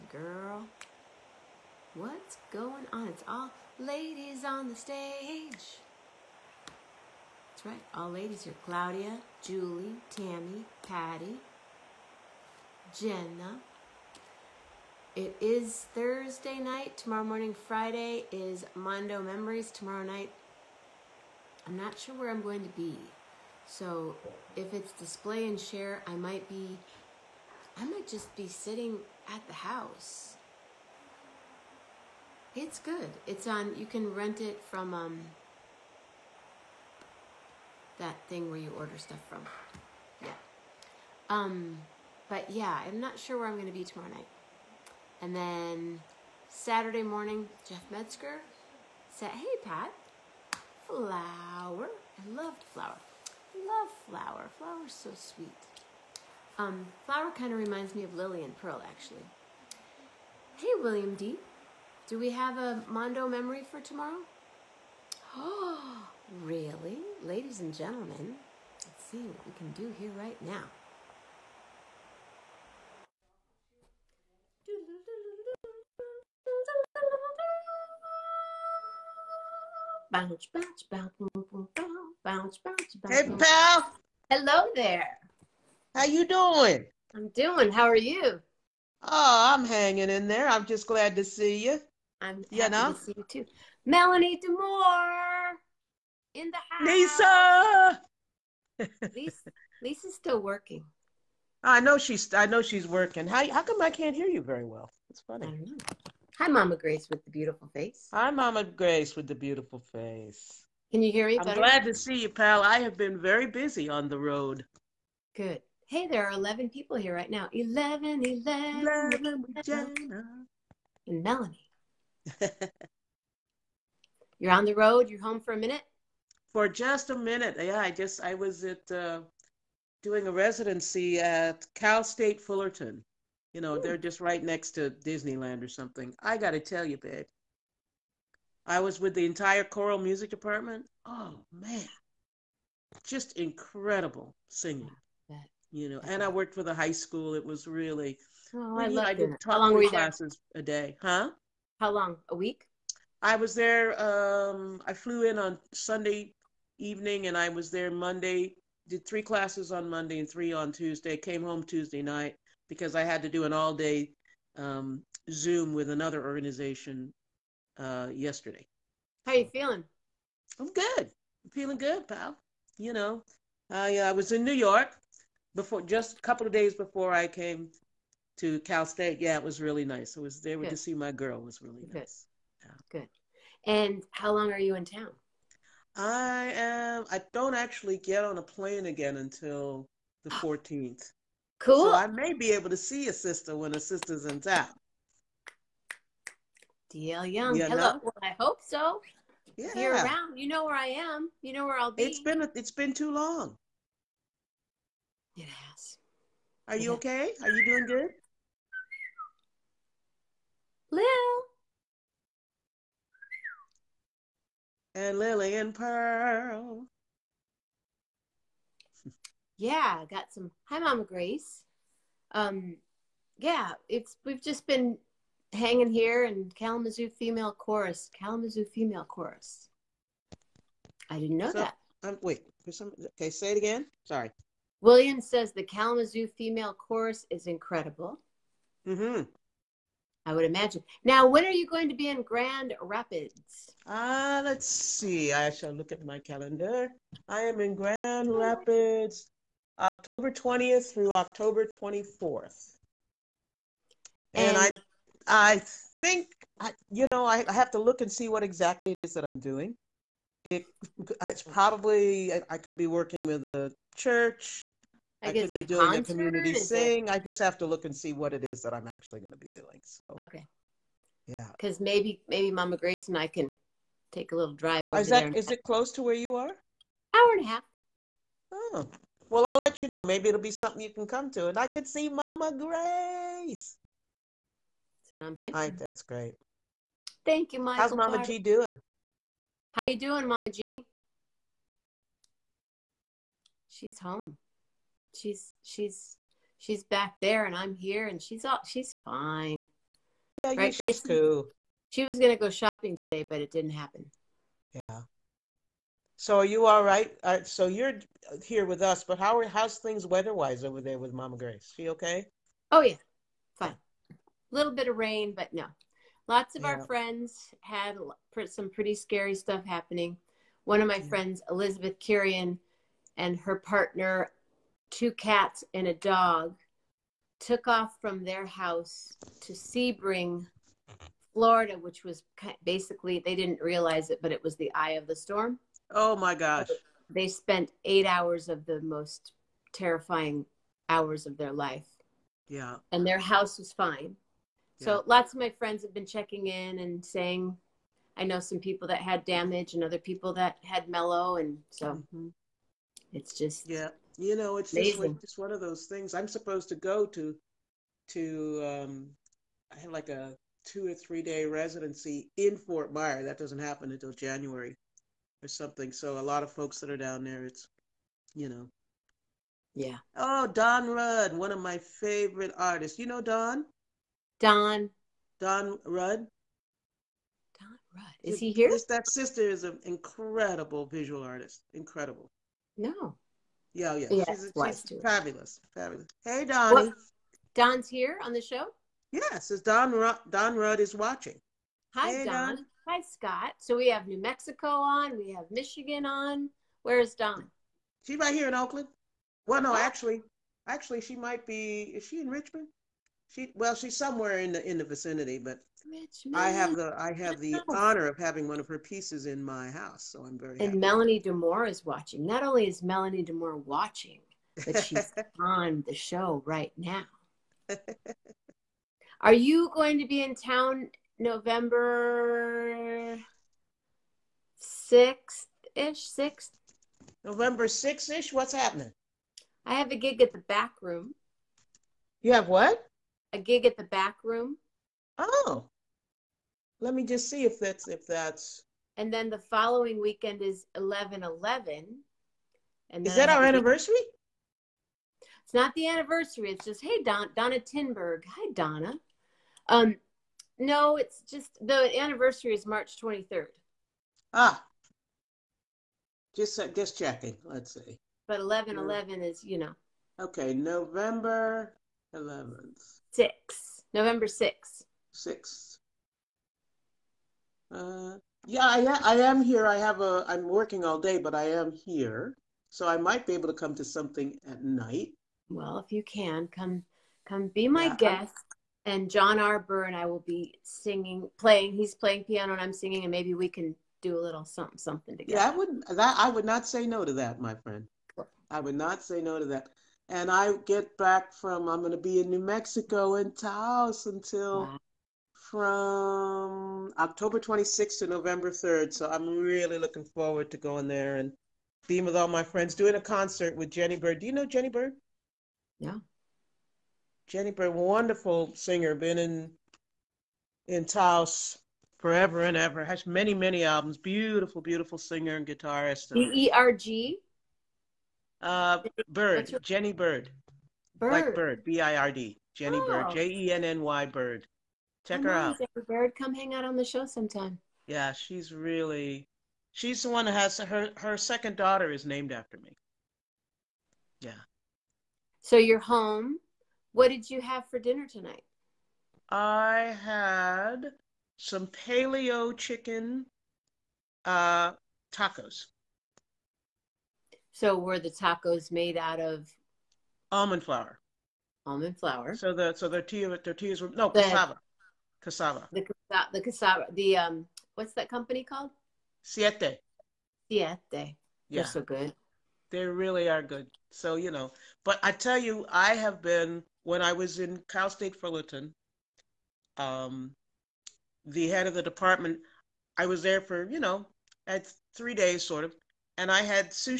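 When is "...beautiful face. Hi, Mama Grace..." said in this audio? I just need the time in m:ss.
1:47.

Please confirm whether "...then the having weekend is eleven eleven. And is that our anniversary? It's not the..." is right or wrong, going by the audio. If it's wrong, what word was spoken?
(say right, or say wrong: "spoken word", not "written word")
wrong: "following", not "having".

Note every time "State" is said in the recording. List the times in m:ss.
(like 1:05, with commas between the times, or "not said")
2:12, 2:58, 9:27.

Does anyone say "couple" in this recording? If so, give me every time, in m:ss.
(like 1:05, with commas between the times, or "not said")
2:56.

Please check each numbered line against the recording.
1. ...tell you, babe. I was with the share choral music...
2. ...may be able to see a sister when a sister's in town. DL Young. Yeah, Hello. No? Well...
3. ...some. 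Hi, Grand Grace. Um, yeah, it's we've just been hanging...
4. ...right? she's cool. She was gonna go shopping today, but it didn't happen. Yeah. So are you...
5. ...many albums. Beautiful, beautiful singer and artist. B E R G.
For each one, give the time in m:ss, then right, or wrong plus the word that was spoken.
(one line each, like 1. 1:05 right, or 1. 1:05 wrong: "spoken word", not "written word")
1. 2:16 wrong: "entire", not "share"
2. 3:12 right
3. 3:40 wrong: "Mama", not "Grand"
4. 5:00 right
5. 8:33 wrong: "guitarist", not "artist".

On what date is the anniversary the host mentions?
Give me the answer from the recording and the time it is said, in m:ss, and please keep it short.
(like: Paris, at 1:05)
March 23, at 7:32.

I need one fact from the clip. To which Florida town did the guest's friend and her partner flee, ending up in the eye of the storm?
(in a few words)
Sebring.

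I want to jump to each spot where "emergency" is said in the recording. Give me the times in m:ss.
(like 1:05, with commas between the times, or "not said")
not said.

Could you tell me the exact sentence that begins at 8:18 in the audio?
So I'm really looking forward to going there and being with all my friends, doing a concert with Jenny Bird.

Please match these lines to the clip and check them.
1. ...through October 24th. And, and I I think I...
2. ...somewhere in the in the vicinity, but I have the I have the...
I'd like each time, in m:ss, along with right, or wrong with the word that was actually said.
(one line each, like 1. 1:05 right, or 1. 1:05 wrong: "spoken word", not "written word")
1. 4:10 right
2. 6:43 right.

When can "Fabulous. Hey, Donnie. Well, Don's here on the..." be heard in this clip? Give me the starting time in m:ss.
6:25.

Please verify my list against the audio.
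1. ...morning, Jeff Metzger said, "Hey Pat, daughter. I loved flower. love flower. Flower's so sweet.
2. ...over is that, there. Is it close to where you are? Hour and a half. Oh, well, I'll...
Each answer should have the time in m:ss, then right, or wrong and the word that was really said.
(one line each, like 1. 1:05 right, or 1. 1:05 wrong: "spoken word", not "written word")
1. 0:47 wrong: "flower", not "daughter"
2. 4:34 right.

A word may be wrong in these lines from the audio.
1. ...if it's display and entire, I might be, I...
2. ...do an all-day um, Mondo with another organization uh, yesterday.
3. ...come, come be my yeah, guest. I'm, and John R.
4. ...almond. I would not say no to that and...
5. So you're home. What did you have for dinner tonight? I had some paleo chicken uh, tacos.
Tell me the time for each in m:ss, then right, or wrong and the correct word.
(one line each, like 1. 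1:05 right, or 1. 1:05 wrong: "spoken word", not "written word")
1. 0:24 wrong: "share", not "entire"
2. 2:43 wrong: "Zoom", not "Mondo"
3. 7:56 right
4. 8:07 wrong: "friend", not "almond"
5. 8:55 right.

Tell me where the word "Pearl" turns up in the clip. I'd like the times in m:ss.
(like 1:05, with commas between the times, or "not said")
0:58, 3:35.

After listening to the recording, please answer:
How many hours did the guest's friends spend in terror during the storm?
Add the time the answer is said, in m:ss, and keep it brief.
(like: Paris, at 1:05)
8, at 5:37.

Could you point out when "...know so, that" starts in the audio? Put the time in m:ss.
3:51.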